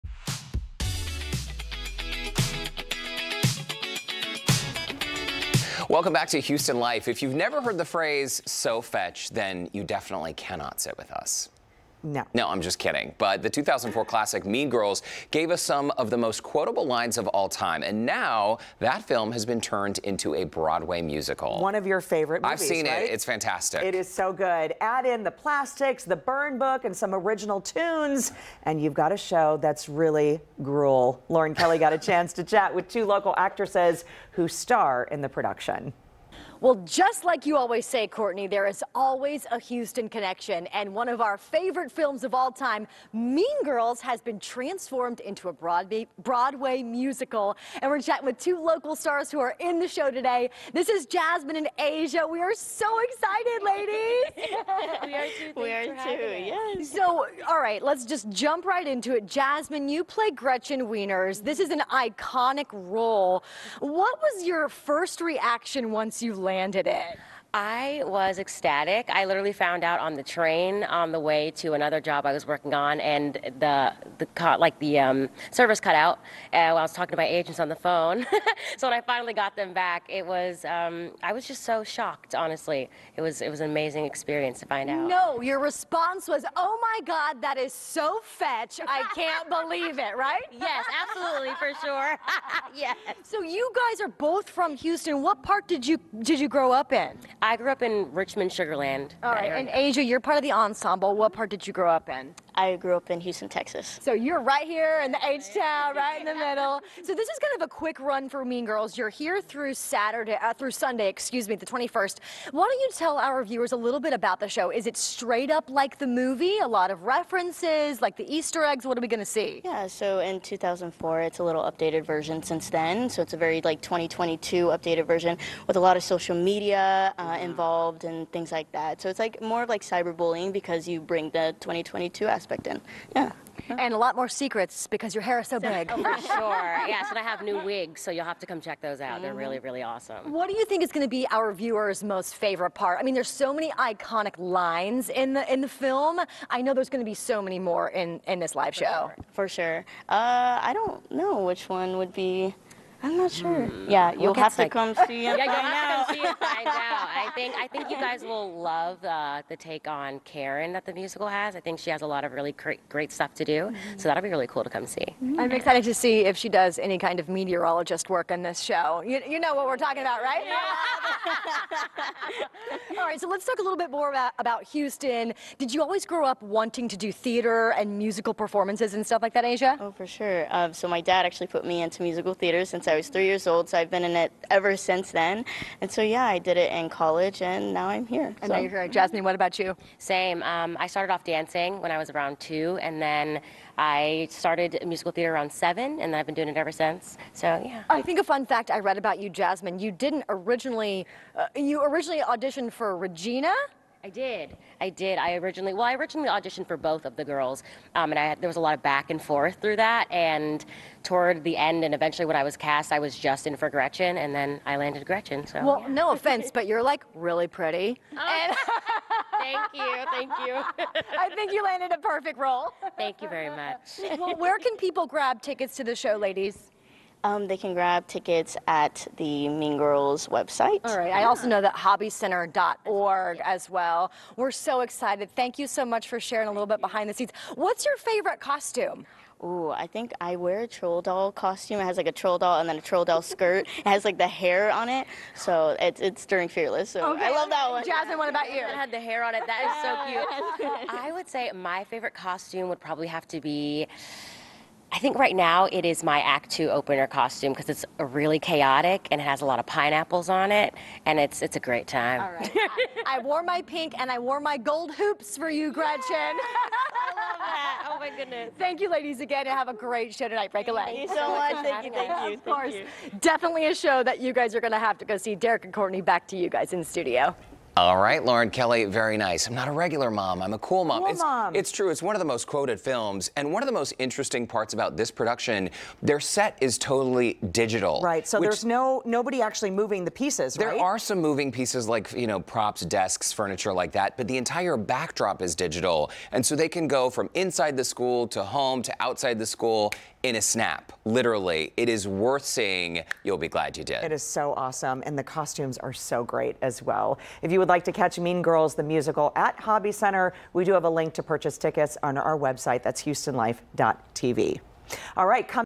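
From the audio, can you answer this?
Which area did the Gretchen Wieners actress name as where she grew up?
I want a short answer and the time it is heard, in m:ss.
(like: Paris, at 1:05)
Richmond, Sugar Land, at 1:38.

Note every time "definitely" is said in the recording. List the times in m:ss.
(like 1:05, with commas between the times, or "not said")
0:09, 4:33.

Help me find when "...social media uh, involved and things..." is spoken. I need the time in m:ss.
2:06.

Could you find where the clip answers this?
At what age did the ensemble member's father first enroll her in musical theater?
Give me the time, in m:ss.
3:03.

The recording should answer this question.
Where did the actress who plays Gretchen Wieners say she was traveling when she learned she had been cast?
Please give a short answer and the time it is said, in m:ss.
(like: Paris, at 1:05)
On the train, at 1:09.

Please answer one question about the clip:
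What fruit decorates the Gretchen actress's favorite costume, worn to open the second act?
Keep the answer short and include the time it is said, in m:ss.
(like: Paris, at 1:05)
Pineapples, at 4:19.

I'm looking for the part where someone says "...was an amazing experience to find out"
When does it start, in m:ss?
1:23.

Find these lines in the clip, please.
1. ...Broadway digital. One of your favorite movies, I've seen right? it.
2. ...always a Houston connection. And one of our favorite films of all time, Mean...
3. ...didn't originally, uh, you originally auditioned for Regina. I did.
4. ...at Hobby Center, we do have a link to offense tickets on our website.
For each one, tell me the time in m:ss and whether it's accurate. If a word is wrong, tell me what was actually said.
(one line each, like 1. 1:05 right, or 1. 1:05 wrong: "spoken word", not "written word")
1. 0:20 wrong: "musical", not "digital"
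2. 0:38 right
3. 3:19 right
4. 5:09 wrong: "purchase", not "offense".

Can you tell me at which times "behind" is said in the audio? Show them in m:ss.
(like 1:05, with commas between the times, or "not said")
3:56.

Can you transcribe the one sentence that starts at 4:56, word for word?
And so they can go from inside the school to home to outside the school in a snap, literally.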